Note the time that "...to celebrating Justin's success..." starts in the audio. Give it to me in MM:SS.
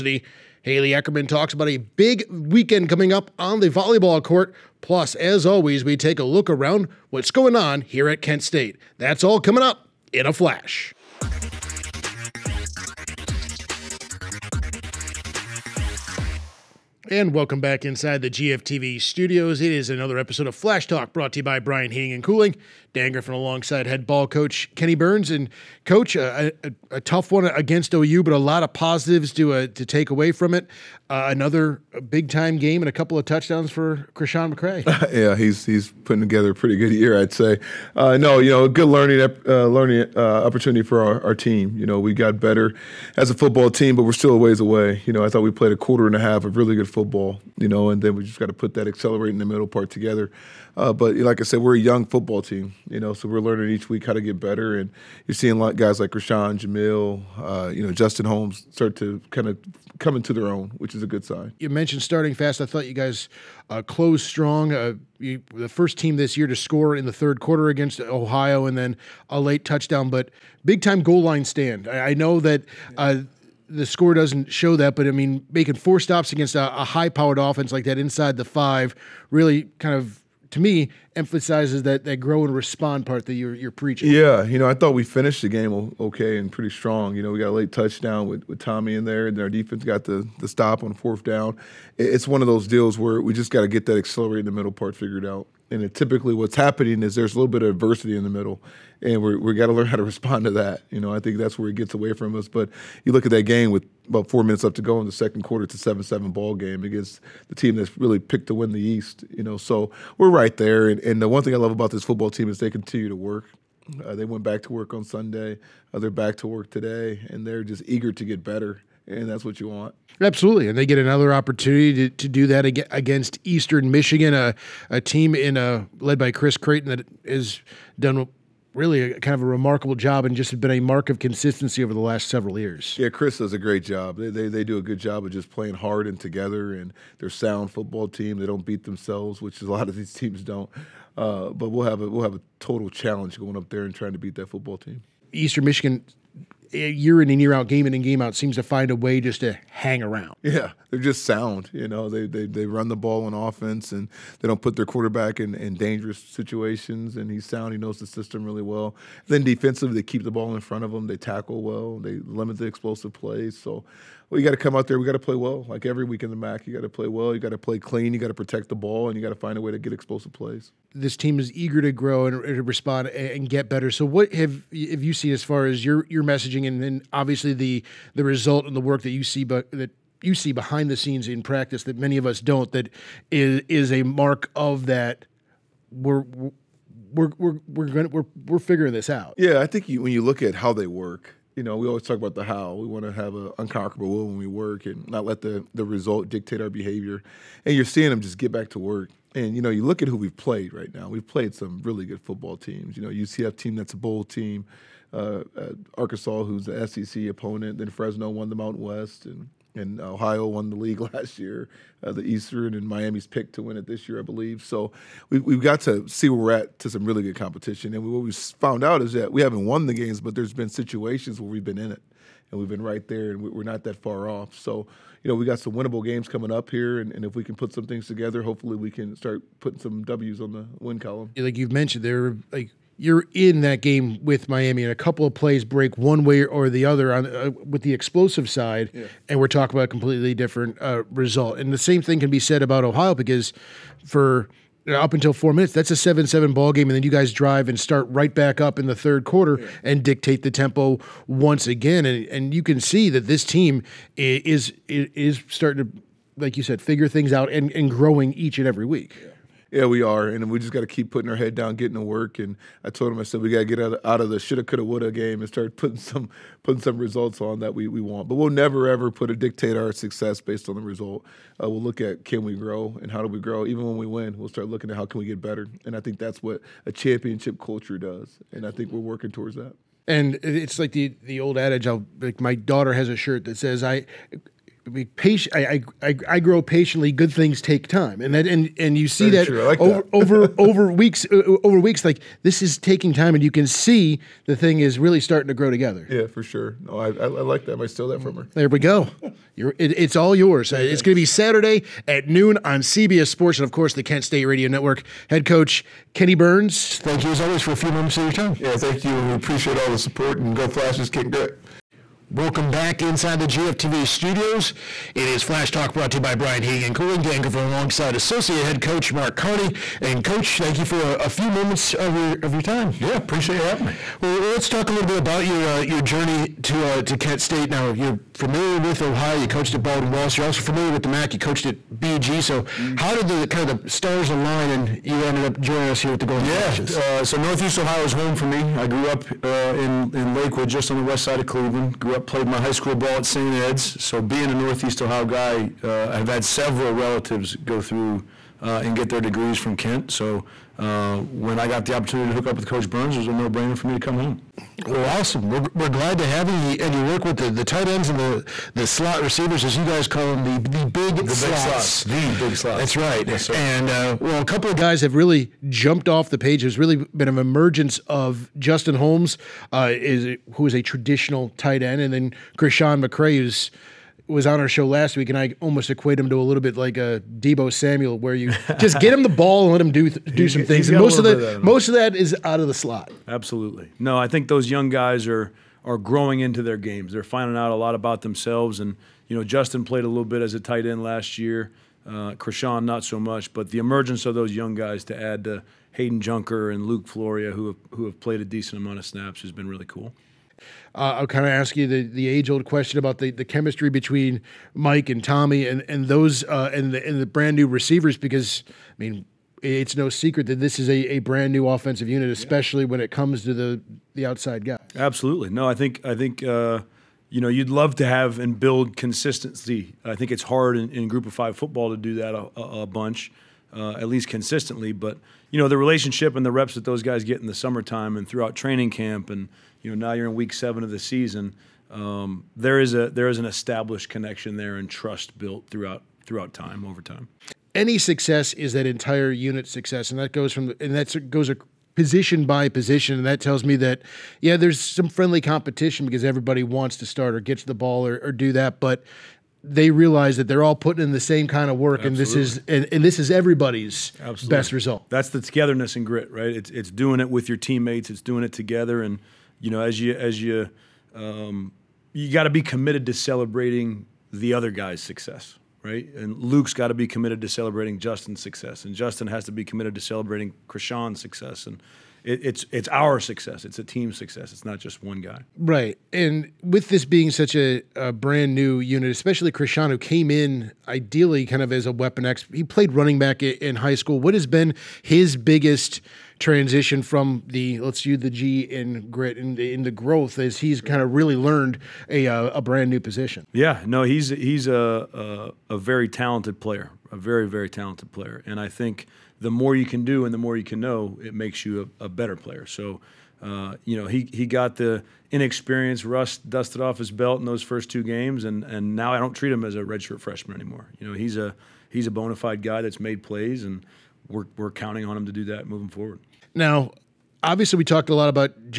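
07:47.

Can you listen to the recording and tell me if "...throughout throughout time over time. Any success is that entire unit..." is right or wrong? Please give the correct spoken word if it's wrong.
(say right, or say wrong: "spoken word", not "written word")
right.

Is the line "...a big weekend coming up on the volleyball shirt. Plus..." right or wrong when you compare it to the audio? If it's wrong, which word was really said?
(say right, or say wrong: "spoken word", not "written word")
wrong: "court", not "shirt".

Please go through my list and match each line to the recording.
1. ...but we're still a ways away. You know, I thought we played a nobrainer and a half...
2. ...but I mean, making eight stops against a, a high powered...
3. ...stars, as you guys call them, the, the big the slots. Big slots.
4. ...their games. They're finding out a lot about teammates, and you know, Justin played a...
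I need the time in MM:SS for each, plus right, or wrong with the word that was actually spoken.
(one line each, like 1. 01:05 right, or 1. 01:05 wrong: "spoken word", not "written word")
1. 00:43 wrong: "quarter", not "nobrainer"
2. 01:14 wrong: "four", not "eight"
3. 05:59 wrong: "receivers", not "stars"
4. 06:26 wrong: "themselves", not "teammates".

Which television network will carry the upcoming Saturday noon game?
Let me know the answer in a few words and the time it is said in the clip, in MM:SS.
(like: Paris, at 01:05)
CBS Sports, at 05:02.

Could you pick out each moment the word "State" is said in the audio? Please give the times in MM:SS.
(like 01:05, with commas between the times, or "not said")
00:08, 05:04, 05:27.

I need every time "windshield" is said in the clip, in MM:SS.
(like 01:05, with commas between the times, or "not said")
not said.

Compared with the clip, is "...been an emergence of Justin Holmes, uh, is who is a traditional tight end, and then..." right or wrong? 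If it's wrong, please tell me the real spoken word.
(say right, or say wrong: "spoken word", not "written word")
right.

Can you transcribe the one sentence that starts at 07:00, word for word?
I think it's hard in, in Group of Five football to do that a, a bunch, uh, at least consistently.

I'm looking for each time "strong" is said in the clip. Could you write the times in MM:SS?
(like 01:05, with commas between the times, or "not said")
01:04, 01:26.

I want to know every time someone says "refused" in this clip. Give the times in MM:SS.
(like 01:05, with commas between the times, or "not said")
not said.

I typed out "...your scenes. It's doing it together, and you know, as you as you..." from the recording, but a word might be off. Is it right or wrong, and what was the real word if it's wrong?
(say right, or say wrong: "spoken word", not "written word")
wrong: "teammates", not "scenes".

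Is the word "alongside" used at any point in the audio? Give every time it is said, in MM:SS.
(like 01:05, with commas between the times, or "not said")
00:23, 05:17.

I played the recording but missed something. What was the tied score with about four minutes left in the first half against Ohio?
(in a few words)
7-7.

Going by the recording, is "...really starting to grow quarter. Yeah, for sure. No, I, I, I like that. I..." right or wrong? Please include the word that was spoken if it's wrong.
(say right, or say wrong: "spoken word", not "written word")
wrong: "together", not "quarter".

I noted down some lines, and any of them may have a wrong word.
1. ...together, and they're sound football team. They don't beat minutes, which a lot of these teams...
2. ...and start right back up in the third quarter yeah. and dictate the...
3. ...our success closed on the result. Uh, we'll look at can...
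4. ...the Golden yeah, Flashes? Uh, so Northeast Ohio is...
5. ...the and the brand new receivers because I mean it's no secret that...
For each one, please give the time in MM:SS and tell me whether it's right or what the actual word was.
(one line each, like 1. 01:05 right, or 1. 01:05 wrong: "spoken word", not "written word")
1. 02:16 wrong: "themselves", not "minutes"
2. 04:07 right
3. 04:29 wrong: "based", not "closed"
4. 05:36 right
5. 06:46 right.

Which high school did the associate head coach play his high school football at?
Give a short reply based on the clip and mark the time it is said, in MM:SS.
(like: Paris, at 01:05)
St. Ed's, at 05:43.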